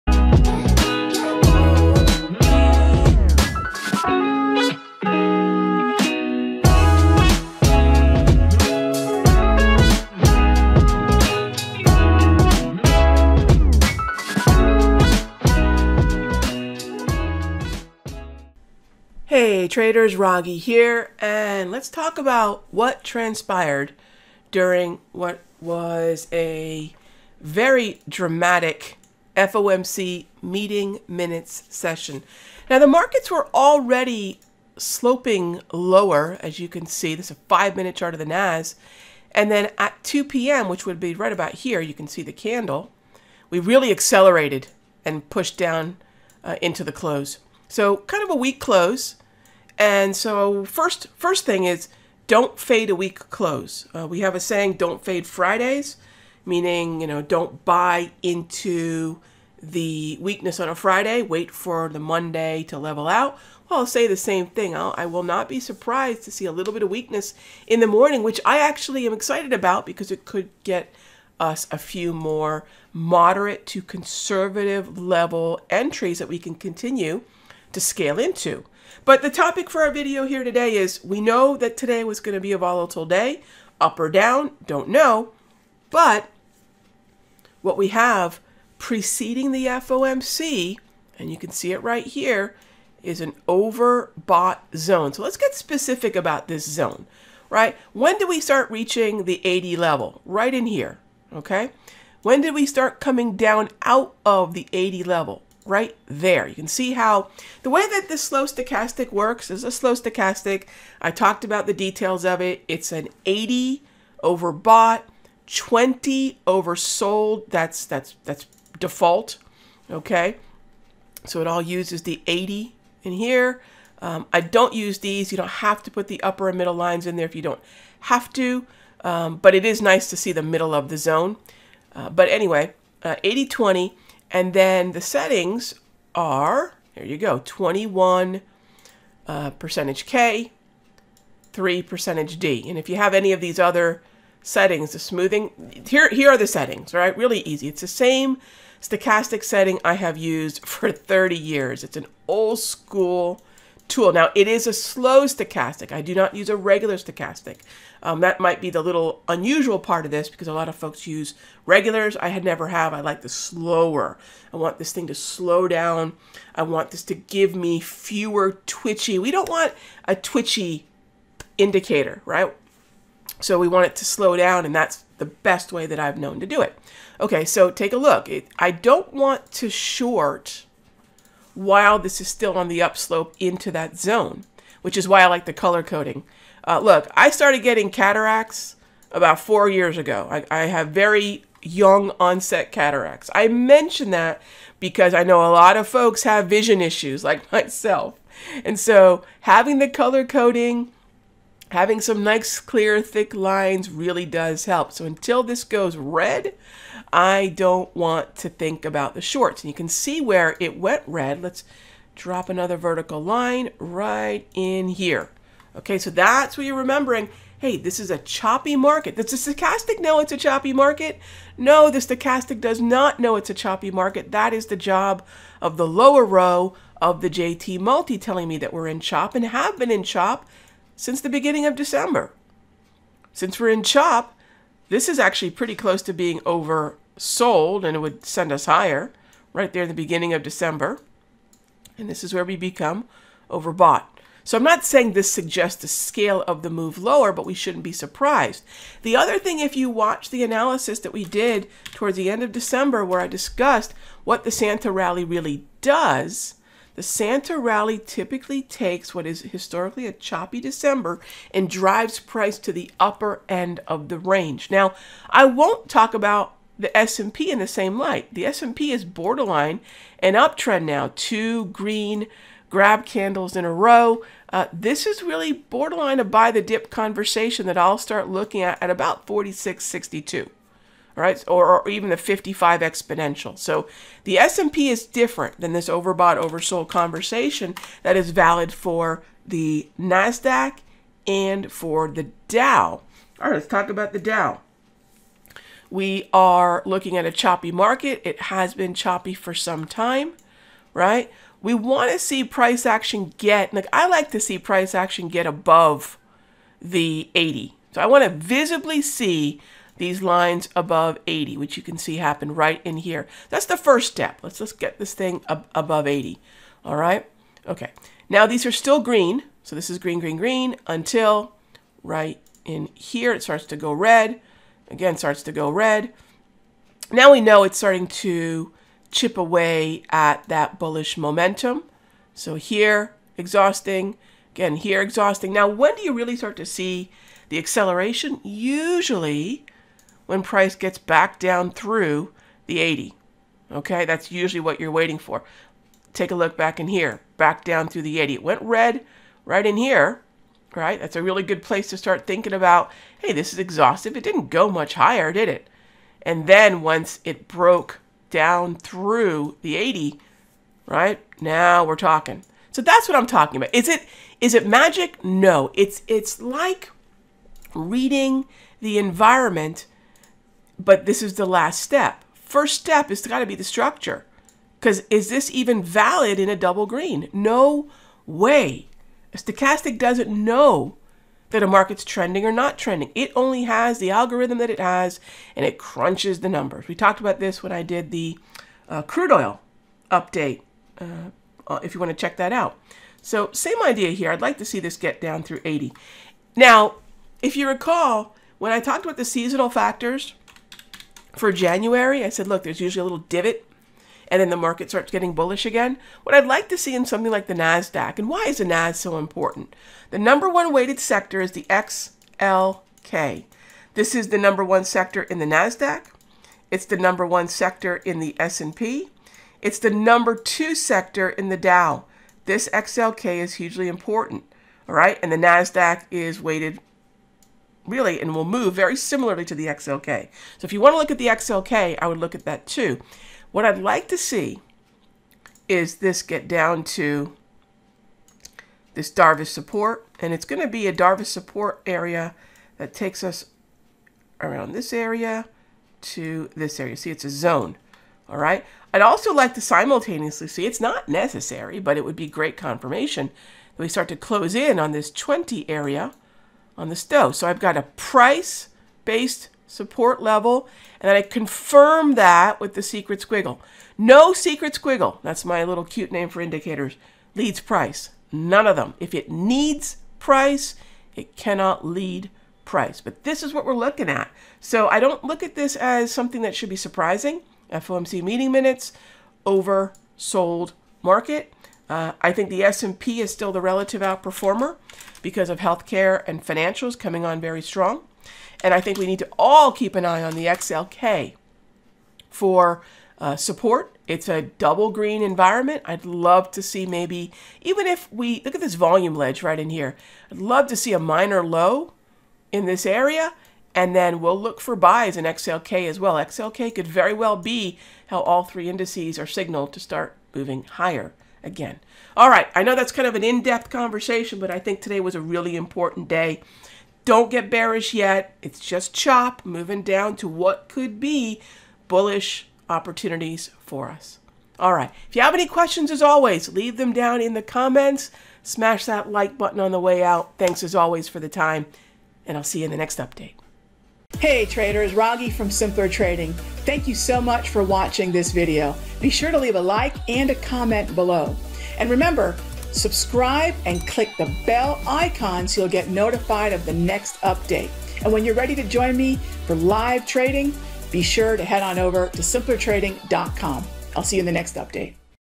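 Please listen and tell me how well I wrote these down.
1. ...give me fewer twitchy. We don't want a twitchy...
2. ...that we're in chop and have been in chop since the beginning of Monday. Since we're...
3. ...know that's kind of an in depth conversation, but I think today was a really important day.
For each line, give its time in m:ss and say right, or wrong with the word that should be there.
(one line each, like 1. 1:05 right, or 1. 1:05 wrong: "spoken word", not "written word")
1. 2:47 right
2. 3:48 wrong: "December", not "Monday"
3. 8:32 right.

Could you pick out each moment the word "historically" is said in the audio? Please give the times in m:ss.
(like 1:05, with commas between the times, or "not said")
4:19.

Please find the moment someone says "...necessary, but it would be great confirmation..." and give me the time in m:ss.
7:31.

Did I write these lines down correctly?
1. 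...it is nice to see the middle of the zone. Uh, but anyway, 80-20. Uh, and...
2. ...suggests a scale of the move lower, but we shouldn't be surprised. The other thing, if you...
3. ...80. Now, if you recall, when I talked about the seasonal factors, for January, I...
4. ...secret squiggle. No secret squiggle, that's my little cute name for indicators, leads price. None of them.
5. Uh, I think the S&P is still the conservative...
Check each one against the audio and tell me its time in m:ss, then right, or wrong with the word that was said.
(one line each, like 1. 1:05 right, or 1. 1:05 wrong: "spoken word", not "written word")
1. 2:09 right
2. 4:05 right
3. 6:35 right
4. 7:42 right
5. 8:01 wrong: "relative", not "conservative".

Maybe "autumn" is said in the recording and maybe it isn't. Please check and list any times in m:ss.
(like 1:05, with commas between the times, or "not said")
not said.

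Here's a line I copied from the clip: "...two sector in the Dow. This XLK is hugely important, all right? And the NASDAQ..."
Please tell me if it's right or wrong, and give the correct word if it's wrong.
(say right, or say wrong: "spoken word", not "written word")
right.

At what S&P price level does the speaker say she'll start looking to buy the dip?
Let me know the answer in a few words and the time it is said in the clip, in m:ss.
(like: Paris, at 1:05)
4662, at 4:39.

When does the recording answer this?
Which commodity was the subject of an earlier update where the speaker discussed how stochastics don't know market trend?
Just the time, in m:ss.
6:29.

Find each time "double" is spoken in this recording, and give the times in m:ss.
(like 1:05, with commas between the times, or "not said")
6:16, 8:14.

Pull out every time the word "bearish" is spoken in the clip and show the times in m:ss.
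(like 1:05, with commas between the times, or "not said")
8:37.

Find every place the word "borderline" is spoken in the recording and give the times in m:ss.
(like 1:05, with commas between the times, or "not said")
4:29, 4:35.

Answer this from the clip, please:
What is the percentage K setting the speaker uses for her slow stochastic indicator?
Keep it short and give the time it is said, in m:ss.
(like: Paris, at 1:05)
21, at 2:17.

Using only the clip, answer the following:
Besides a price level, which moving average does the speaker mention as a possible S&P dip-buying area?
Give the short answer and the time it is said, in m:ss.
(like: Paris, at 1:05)
55 exponential, at 4:42.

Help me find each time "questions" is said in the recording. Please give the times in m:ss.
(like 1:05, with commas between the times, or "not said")
8:45.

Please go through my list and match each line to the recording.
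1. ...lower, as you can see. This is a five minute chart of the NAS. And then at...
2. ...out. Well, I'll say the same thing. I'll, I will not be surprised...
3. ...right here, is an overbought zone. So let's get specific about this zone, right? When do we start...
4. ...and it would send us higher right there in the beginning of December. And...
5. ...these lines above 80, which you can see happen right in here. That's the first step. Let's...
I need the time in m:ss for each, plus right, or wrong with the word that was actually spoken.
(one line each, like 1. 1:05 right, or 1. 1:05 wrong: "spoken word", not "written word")
1. 0:35 right
2. 1:03 right
3. 1:31 right
4. 3:57 right
5. 5:10 right.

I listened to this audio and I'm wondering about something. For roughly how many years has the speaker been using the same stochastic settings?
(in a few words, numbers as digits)
30 years.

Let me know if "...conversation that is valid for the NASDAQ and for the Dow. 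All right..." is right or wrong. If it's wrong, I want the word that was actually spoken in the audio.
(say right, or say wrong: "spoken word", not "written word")
right.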